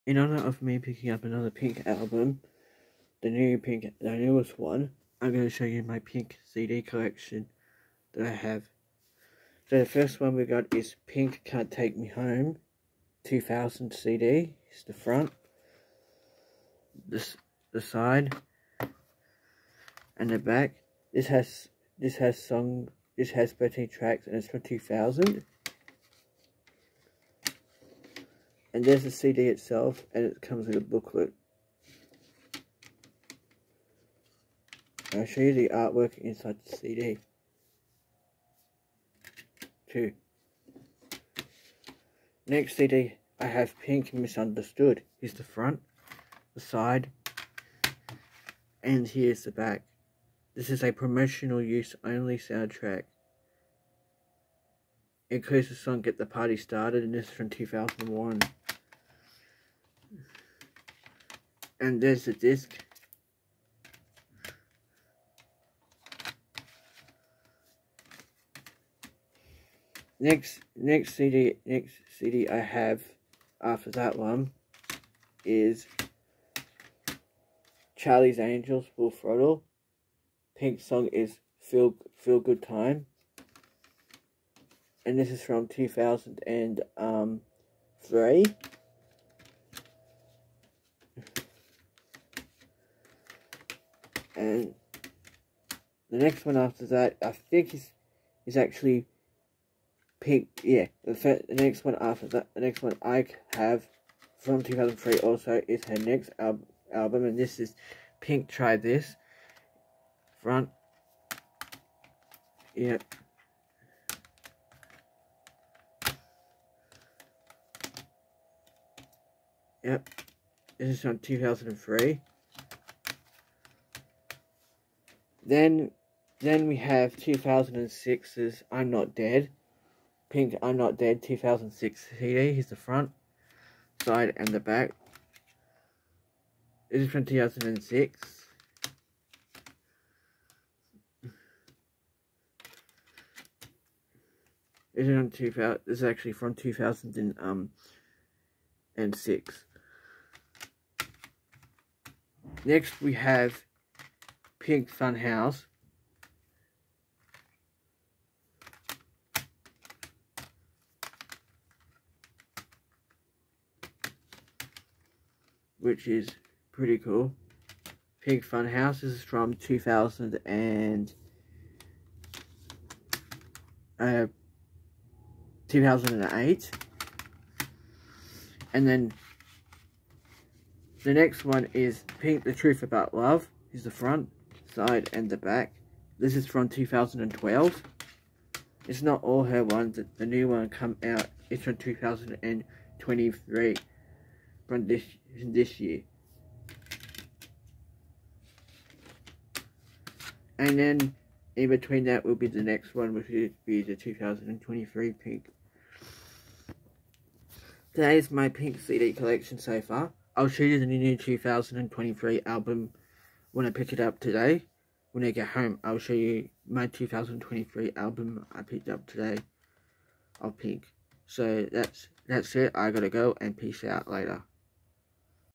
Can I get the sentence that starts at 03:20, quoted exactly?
And then in between that will be the next one, which will be the 2023 pink.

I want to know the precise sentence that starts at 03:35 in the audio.
When I get home, I'll show you my 2023 album I picked up today of Pink.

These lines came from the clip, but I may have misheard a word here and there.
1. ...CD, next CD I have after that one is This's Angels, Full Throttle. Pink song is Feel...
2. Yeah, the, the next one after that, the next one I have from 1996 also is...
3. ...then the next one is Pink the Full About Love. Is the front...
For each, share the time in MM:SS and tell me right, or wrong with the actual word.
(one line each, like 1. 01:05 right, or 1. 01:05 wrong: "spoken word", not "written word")
1. 01:11 wrong: "Charlie", not "This"
2. 01:40 wrong: "2003", not "1996"
3. 02:58 wrong: "Truth", not "Full".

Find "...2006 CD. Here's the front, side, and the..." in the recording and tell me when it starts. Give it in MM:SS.
02:11.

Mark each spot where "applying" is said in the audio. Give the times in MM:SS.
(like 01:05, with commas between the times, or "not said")
not said.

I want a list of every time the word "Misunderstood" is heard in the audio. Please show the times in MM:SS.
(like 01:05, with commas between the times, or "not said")
00:44.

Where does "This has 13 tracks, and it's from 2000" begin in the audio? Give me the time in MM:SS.
00:23.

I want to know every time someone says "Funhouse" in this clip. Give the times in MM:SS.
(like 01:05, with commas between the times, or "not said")
02:34, 02:48.